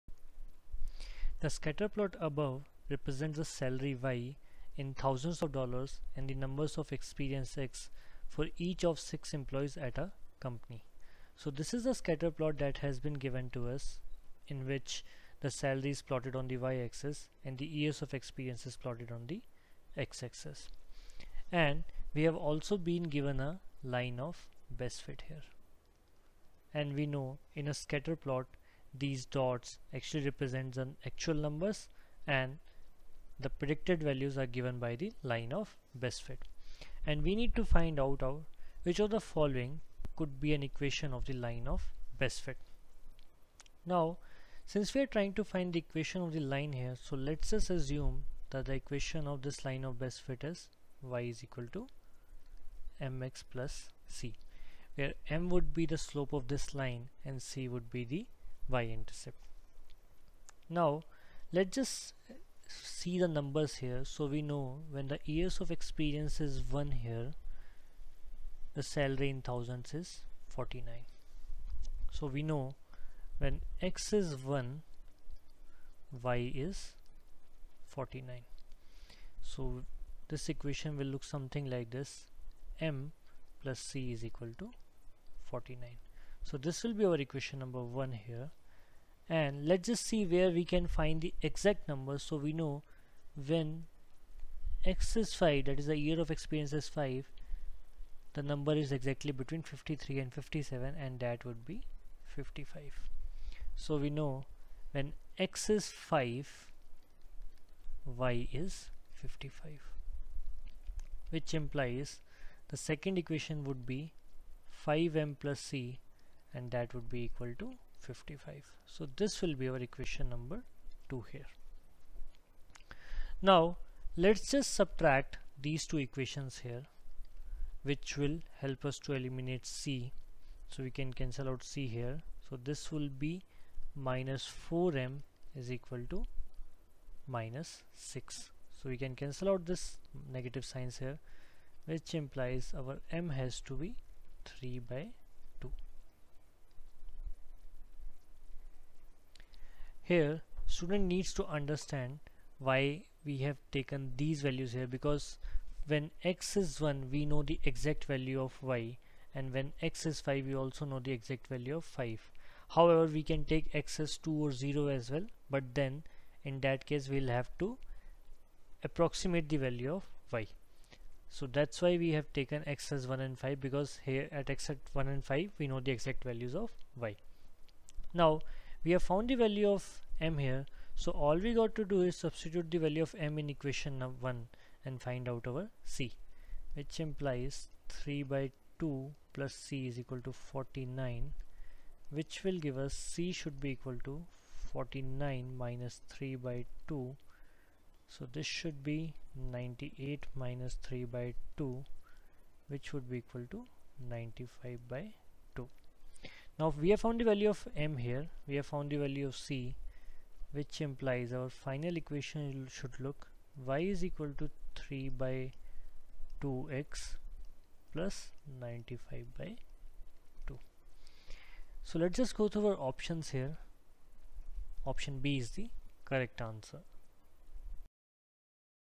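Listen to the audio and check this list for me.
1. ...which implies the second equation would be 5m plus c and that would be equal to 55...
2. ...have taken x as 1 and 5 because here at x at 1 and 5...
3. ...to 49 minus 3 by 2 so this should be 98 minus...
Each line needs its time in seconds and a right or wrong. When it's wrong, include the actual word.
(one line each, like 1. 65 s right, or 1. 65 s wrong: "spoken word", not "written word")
1. 111 s right
2. 172 s right
3. 194 s right.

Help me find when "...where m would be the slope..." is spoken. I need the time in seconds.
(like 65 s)
54 s.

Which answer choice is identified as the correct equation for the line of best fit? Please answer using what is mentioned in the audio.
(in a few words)
Option B.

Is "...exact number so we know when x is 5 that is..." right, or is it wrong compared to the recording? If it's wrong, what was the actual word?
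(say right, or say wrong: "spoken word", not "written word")
right.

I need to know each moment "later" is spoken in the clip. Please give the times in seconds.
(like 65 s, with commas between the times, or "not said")
not said.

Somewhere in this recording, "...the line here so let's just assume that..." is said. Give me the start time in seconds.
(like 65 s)
46 s.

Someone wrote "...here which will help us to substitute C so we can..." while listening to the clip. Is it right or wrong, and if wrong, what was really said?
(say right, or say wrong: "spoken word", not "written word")
wrong: "eliminate", not "substitute".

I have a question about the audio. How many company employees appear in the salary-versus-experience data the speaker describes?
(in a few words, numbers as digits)
6.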